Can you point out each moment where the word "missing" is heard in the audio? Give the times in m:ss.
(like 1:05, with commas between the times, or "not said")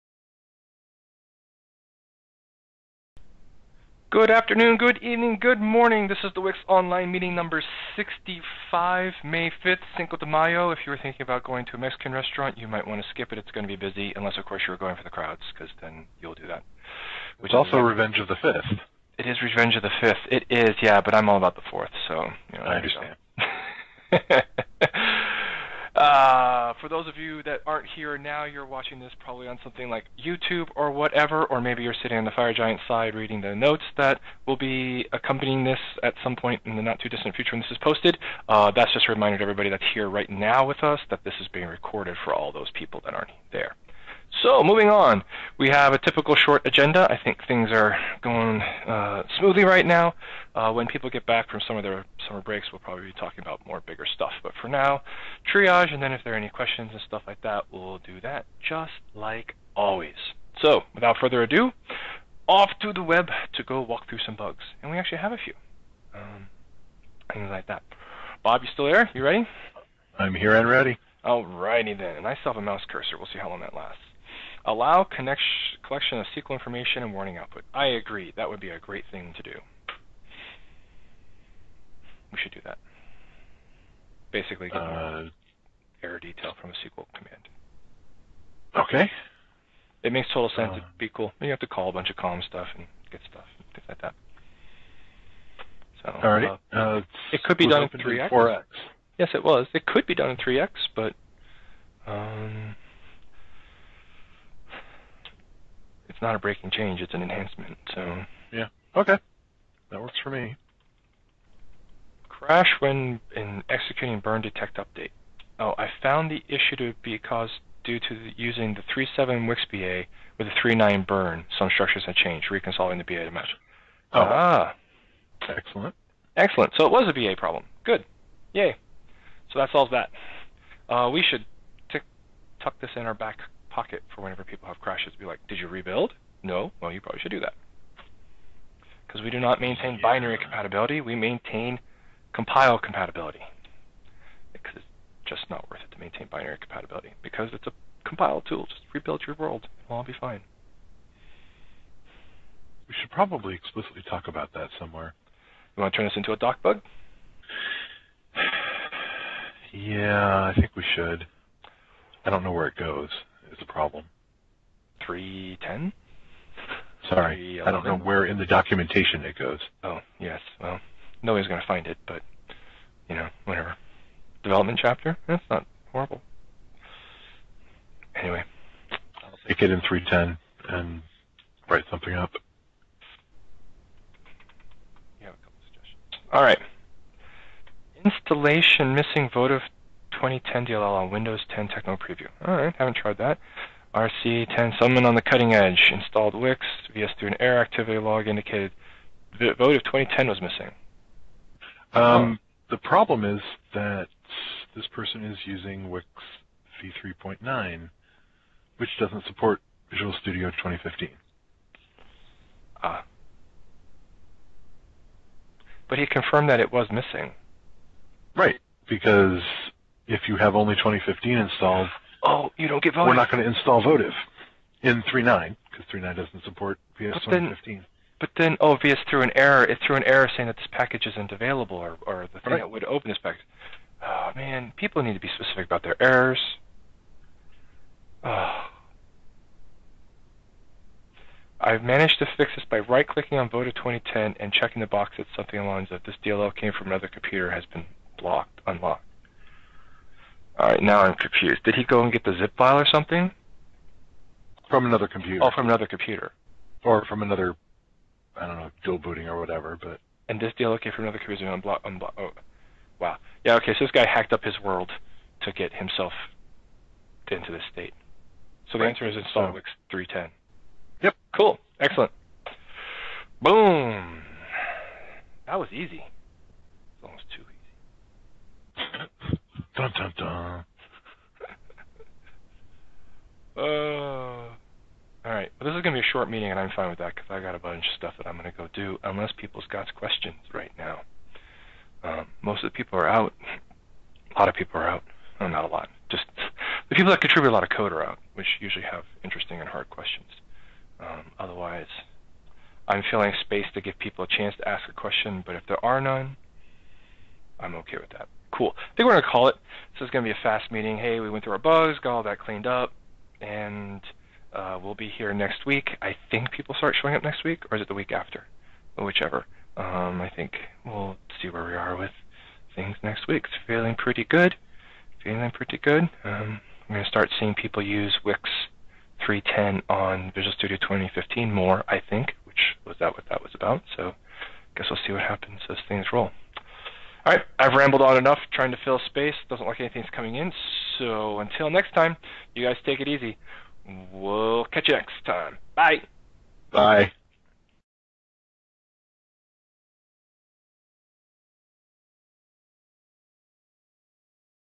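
3:08, 3:20, 3:36.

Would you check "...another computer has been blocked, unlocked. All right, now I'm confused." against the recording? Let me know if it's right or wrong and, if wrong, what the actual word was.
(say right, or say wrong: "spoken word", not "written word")
right.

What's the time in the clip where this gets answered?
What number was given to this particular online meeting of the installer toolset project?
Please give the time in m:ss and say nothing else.
0:07.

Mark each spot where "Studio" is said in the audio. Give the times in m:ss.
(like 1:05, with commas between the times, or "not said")
3:30, 5:30.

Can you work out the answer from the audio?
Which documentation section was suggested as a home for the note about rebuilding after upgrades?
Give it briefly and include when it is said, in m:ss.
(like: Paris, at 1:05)
Development chapter, at 2:54.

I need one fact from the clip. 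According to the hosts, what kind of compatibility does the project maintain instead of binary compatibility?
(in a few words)
compile compatibility.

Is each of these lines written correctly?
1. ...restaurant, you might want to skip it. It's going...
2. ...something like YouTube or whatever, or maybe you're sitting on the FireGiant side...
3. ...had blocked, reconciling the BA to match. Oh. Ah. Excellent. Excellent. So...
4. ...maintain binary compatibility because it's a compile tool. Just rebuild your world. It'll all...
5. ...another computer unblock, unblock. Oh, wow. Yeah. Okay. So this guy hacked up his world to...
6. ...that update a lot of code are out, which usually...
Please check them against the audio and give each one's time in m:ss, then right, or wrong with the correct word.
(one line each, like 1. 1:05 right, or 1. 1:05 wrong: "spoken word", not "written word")
1. 0:12 right
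2. 0:29 right
3. 2:02 wrong: "changed", not "blocked"
4. 2:25 right
5. 4:21 right
6. 4:57 wrong: "contribute", not "update".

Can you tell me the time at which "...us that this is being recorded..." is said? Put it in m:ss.
0:40.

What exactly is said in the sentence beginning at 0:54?
But for now, triage, and then if there are any questions and stuff like that, we'll do that just like always.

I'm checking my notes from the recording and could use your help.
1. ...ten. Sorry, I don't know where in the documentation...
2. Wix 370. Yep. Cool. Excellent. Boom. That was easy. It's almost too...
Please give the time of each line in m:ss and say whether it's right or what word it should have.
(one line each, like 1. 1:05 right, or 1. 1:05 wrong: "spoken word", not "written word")
1. 2:45 right
2. 4:29 wrong: "310", not "370".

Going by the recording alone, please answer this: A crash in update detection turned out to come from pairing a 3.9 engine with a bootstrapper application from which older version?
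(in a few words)
3.7.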